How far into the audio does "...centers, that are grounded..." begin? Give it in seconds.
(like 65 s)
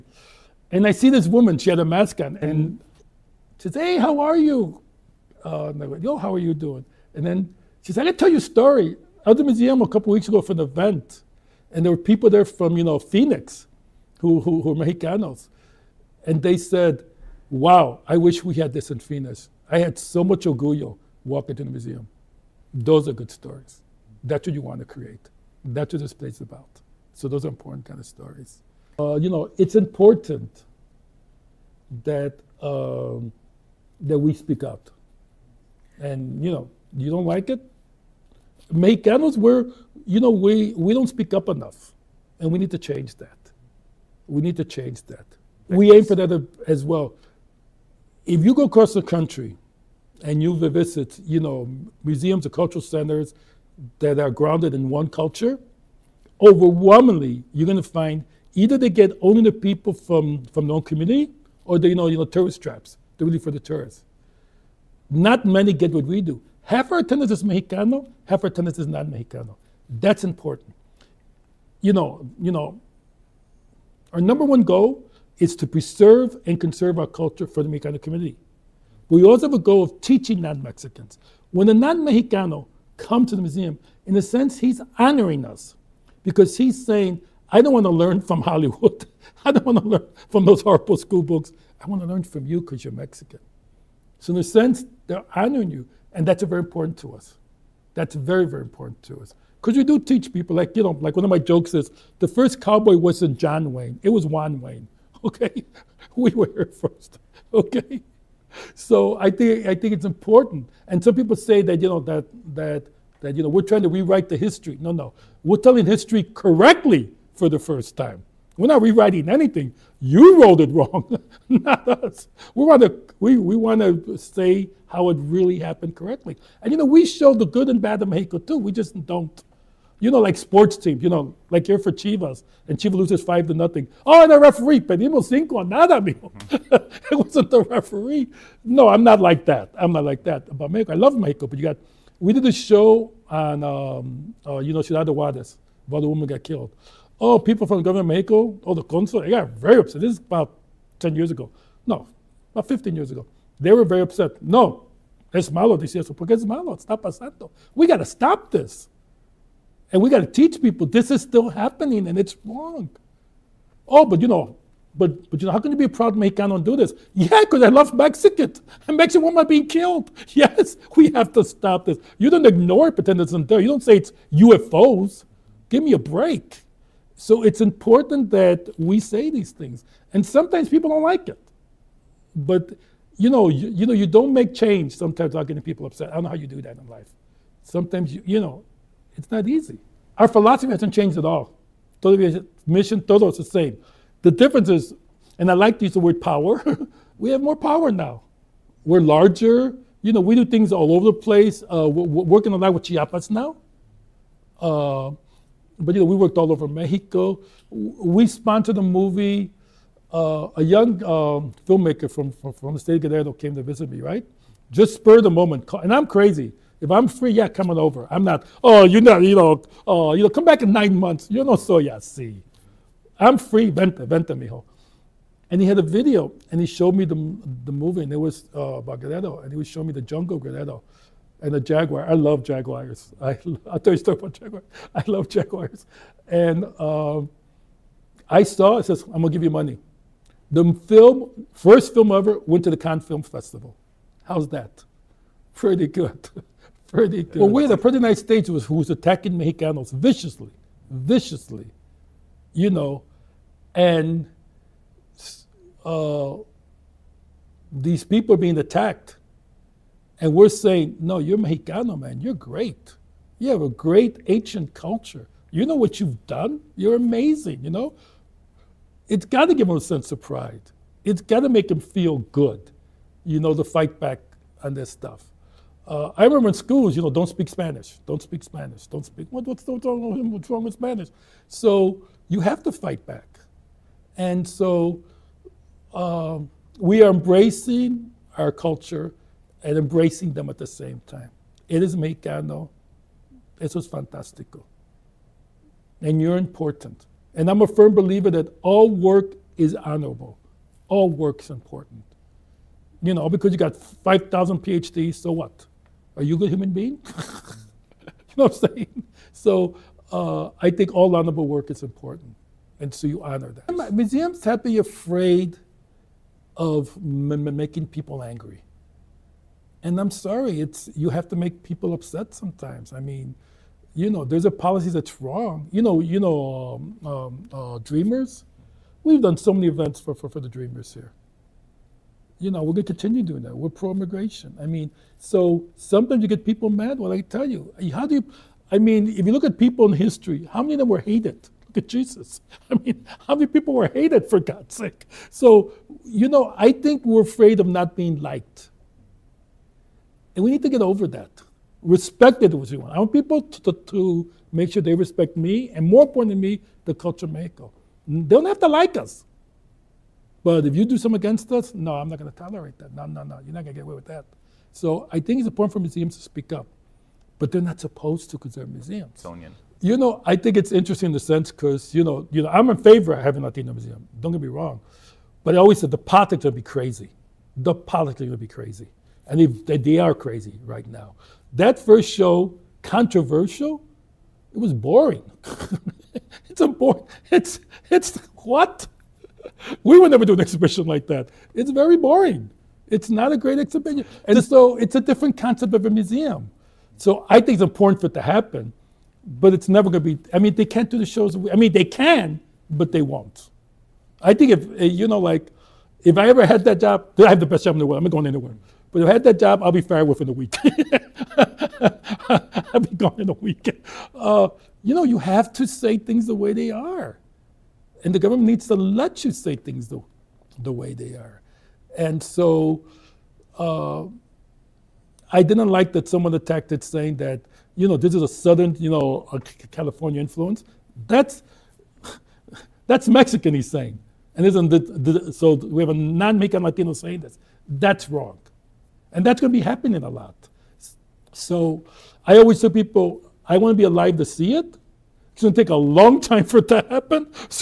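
52 s.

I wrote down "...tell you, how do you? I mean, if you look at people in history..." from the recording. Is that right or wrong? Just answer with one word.
right.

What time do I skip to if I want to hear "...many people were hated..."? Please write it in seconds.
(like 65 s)
343 s.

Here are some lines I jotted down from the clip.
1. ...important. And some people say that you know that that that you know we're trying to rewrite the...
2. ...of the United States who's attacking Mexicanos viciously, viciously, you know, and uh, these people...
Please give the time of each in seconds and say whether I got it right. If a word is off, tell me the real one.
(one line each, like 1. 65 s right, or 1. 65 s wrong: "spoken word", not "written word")
1. 110 s right
2. 247 s right.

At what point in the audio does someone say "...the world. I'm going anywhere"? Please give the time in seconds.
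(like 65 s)
407 s.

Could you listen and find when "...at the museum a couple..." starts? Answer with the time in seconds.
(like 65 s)
9 s.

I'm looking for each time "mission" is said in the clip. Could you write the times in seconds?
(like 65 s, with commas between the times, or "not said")
192 s.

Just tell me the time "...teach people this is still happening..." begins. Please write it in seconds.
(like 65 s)
160 s.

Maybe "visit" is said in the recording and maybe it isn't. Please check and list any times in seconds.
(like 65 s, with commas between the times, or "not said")
50 s, 213 s.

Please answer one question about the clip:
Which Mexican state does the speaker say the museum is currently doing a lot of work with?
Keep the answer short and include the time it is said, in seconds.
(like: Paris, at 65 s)
Chiapas, at 202 s.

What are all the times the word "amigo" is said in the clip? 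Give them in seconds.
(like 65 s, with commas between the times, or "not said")
135 s.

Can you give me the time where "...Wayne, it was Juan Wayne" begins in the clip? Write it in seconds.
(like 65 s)
103 s.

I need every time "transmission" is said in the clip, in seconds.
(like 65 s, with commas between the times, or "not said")
not said.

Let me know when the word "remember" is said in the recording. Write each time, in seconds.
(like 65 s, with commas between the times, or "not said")
276 s.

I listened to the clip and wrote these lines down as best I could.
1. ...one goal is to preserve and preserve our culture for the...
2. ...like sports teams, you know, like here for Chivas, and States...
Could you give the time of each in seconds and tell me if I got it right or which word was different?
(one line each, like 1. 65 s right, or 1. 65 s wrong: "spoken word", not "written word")
1. 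74 s wrong: "conserve", not "preserve"
2. 130 s wrong: "Chivas", not "States".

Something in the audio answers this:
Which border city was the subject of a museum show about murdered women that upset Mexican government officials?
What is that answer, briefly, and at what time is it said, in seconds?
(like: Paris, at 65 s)
Ciudad Juarez, at 144 s.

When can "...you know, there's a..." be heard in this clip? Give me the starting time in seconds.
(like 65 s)
323 s.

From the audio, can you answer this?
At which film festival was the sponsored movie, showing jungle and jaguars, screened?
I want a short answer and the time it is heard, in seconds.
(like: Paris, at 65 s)
Cannes Film Festival, at 242 s.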